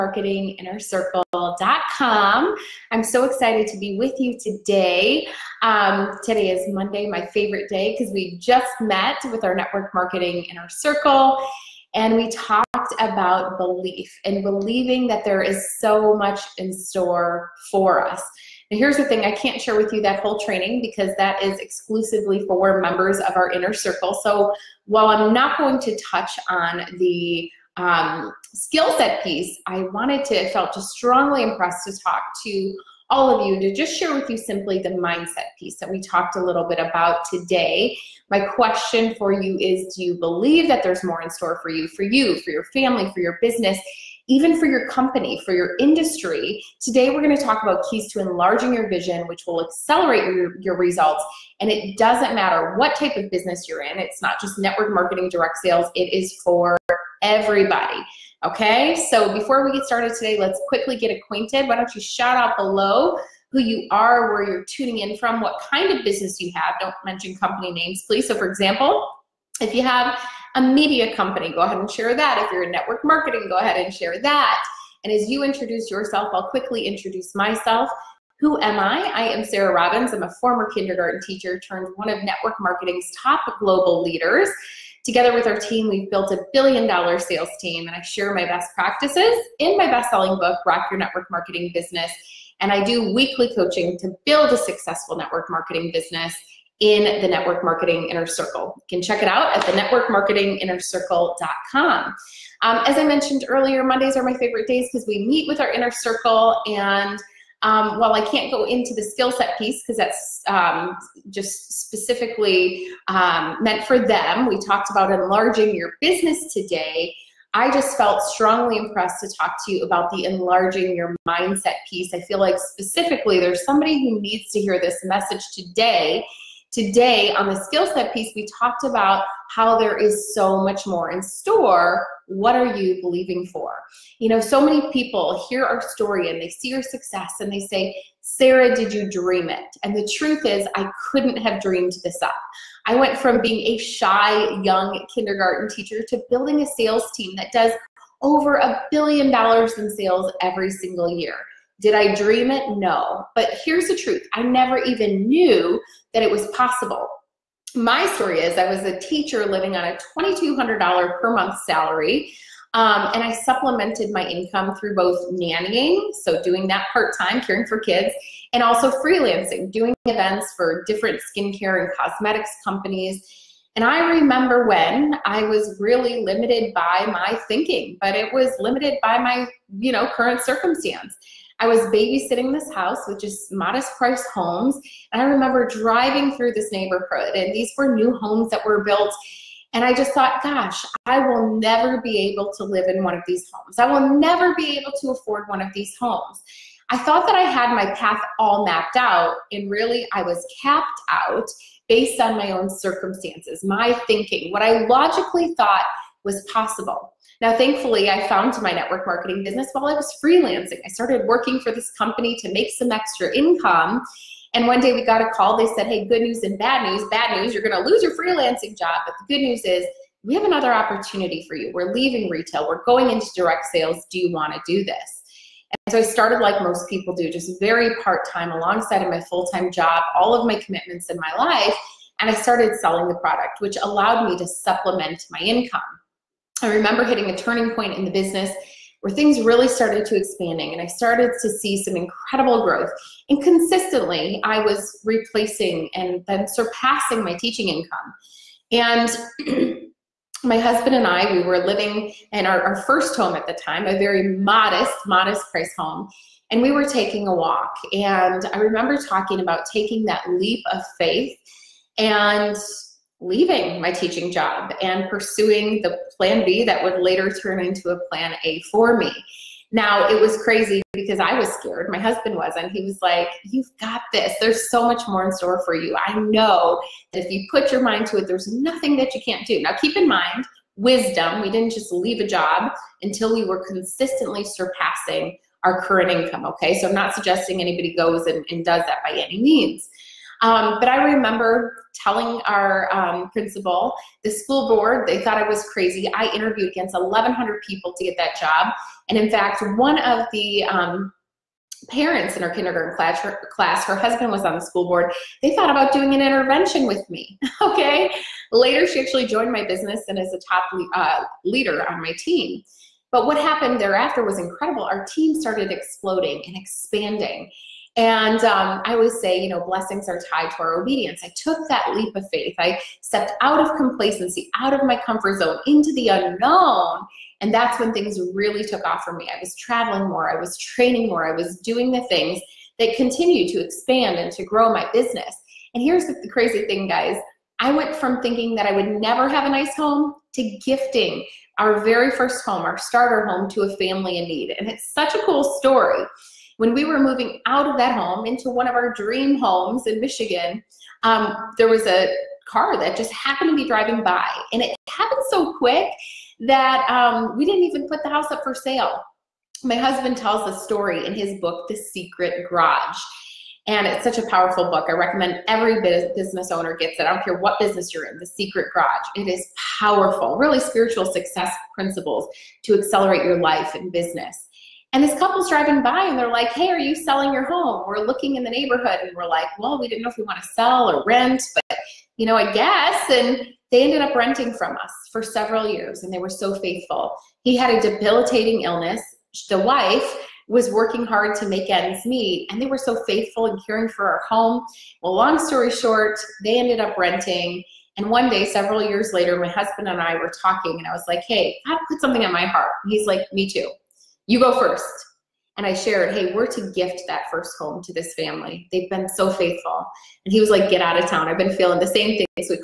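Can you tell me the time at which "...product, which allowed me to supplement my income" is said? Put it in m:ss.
3:53.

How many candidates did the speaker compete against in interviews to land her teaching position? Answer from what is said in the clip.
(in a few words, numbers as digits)
1,100.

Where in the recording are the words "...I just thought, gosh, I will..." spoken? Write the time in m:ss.
3:09.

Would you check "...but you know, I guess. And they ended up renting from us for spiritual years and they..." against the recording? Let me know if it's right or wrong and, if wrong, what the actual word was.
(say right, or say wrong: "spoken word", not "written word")
wrong: "several", not "spiritual".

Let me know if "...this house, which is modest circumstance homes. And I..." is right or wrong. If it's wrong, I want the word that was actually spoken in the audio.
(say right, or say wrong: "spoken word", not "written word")
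wrong: "price", not "circumstance".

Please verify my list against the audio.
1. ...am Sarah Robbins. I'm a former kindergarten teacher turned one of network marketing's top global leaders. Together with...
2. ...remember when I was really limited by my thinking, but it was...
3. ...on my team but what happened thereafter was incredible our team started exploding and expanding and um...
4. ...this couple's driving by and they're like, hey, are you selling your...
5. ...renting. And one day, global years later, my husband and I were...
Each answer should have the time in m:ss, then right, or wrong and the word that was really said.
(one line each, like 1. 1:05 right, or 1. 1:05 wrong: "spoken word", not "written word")
1. 1:19 right
2. 2:54 right
3. 5:11 right
4. 6:15 right
5. 6:36 wrong: "several", not "global".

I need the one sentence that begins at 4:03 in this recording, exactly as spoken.
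And consistently, I was replacing and then surpassing my teaching income.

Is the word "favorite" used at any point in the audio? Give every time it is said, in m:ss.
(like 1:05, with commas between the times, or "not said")
0:07, 1:44.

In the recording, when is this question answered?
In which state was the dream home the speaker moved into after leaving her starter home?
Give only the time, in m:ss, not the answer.
5:49.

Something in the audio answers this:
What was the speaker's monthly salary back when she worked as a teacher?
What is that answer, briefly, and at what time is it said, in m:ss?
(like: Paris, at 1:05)
$2,200, at 2:40.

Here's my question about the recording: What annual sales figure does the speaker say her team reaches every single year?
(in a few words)
over a billion dollars.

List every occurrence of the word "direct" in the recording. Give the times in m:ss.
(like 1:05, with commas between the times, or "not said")
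0:55, 3:43.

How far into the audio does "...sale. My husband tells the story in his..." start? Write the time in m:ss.
5:58.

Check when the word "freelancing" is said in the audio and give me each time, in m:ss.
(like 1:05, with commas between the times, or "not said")
2:48, 3:30, 3:38.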